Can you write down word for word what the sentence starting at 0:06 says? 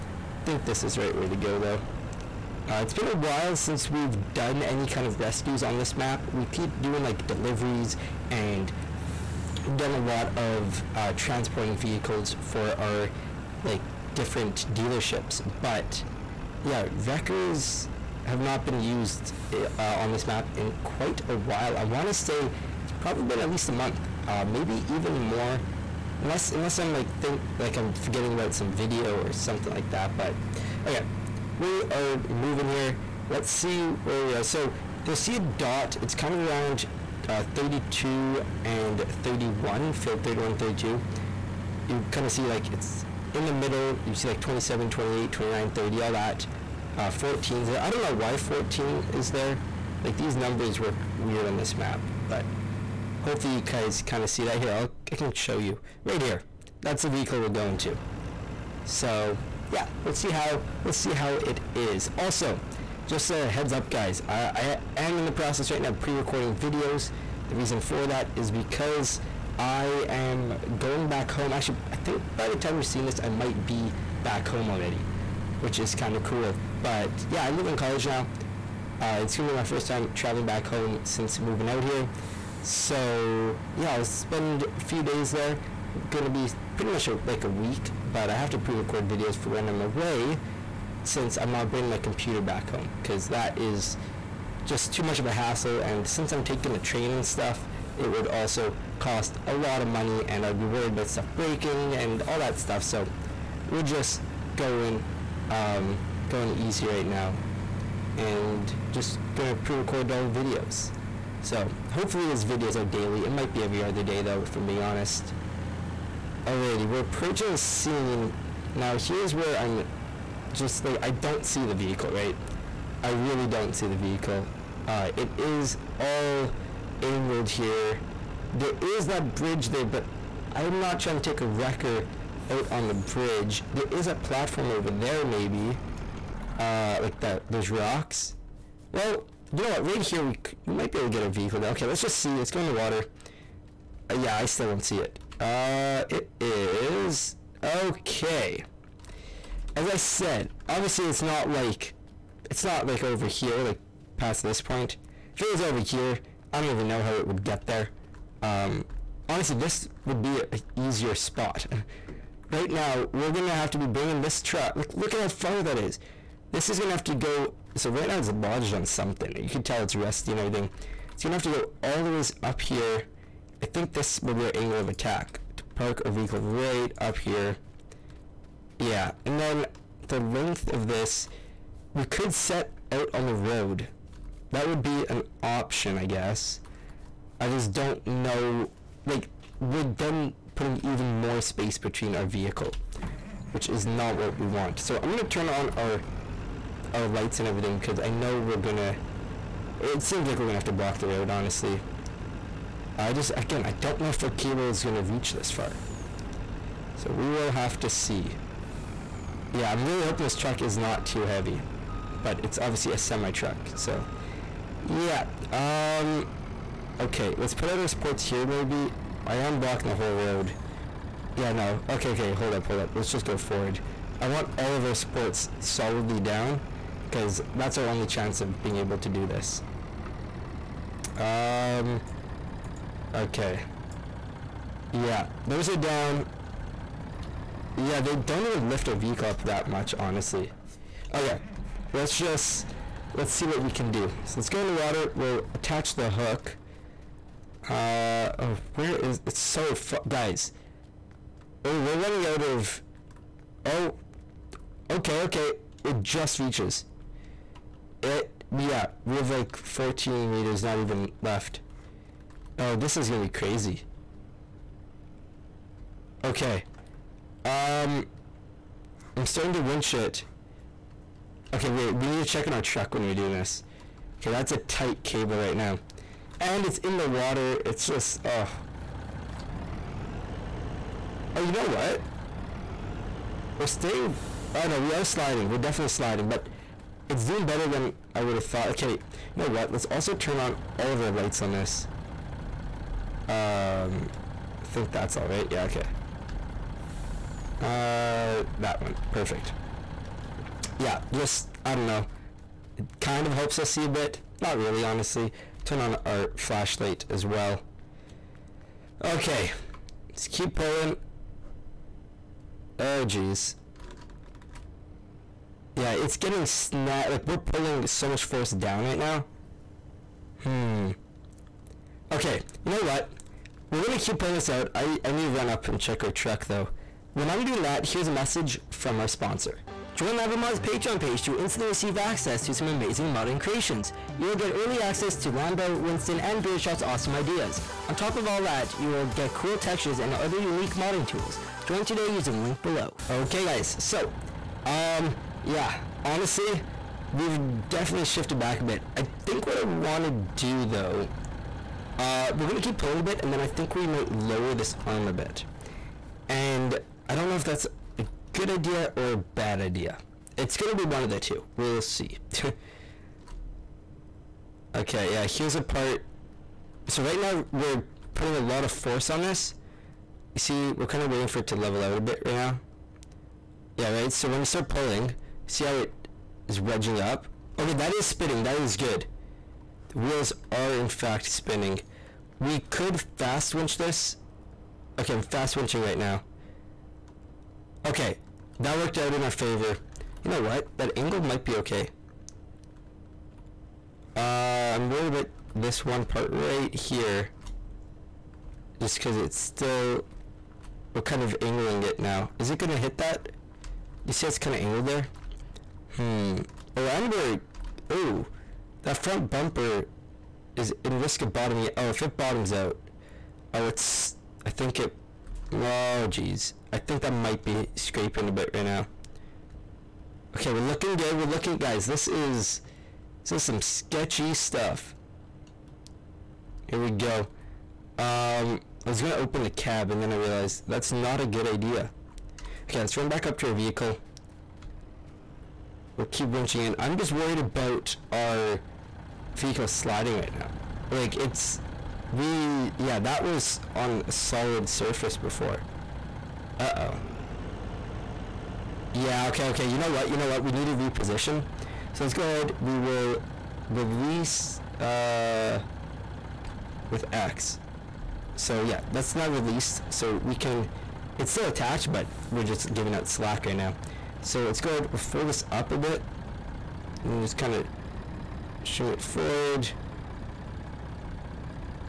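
We keep doing like deliveries and we've done a lot of uh, transporting vehicles for our like different dealerships.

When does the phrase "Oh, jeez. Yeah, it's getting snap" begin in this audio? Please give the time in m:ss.
5:12.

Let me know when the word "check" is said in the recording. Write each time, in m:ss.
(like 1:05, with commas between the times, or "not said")
4:32, 5:25.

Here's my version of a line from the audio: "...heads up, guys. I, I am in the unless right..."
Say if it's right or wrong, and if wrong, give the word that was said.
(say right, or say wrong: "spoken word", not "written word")
wrong: "process", not "unless".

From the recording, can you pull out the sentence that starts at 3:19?
It seems like we're going to have to block the road, honestly.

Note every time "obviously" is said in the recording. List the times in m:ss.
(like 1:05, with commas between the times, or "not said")
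2:30, 3:32.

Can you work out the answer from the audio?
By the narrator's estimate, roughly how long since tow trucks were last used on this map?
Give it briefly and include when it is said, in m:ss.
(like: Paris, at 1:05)
a month, at 0:23.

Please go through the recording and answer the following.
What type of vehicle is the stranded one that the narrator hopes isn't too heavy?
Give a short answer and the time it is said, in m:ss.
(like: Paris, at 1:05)
semi-truck, at 3:32.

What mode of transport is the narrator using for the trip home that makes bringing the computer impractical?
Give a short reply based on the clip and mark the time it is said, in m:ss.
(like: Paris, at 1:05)
train, at 1:36.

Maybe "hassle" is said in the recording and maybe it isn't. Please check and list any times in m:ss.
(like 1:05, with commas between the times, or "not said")
1:35.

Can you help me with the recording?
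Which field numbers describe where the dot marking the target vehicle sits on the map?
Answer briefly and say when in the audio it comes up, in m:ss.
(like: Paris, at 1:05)
31 32, at 0:39.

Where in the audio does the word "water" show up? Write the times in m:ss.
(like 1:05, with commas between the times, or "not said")
2:22, 4:04, 4:37.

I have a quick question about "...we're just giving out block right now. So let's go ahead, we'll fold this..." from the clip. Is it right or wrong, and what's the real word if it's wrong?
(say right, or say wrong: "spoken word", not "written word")
wrong: "slack", not "block".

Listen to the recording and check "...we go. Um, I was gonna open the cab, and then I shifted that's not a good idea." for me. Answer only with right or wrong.
wrong.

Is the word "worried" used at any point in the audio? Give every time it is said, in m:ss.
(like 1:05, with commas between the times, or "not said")
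1:40, 6:34, 7:17.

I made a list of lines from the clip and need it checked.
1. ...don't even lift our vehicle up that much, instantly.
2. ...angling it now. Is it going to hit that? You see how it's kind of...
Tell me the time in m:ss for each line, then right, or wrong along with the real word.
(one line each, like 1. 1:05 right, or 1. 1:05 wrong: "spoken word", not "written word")
1. 3:58 wrong: "honestly", not "instantly"
2. 6:41 right.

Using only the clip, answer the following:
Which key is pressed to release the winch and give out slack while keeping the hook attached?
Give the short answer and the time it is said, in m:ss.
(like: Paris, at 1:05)
X, at 7:37.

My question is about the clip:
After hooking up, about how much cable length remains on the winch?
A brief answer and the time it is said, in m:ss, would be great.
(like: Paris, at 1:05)
14 meters, at 4:19.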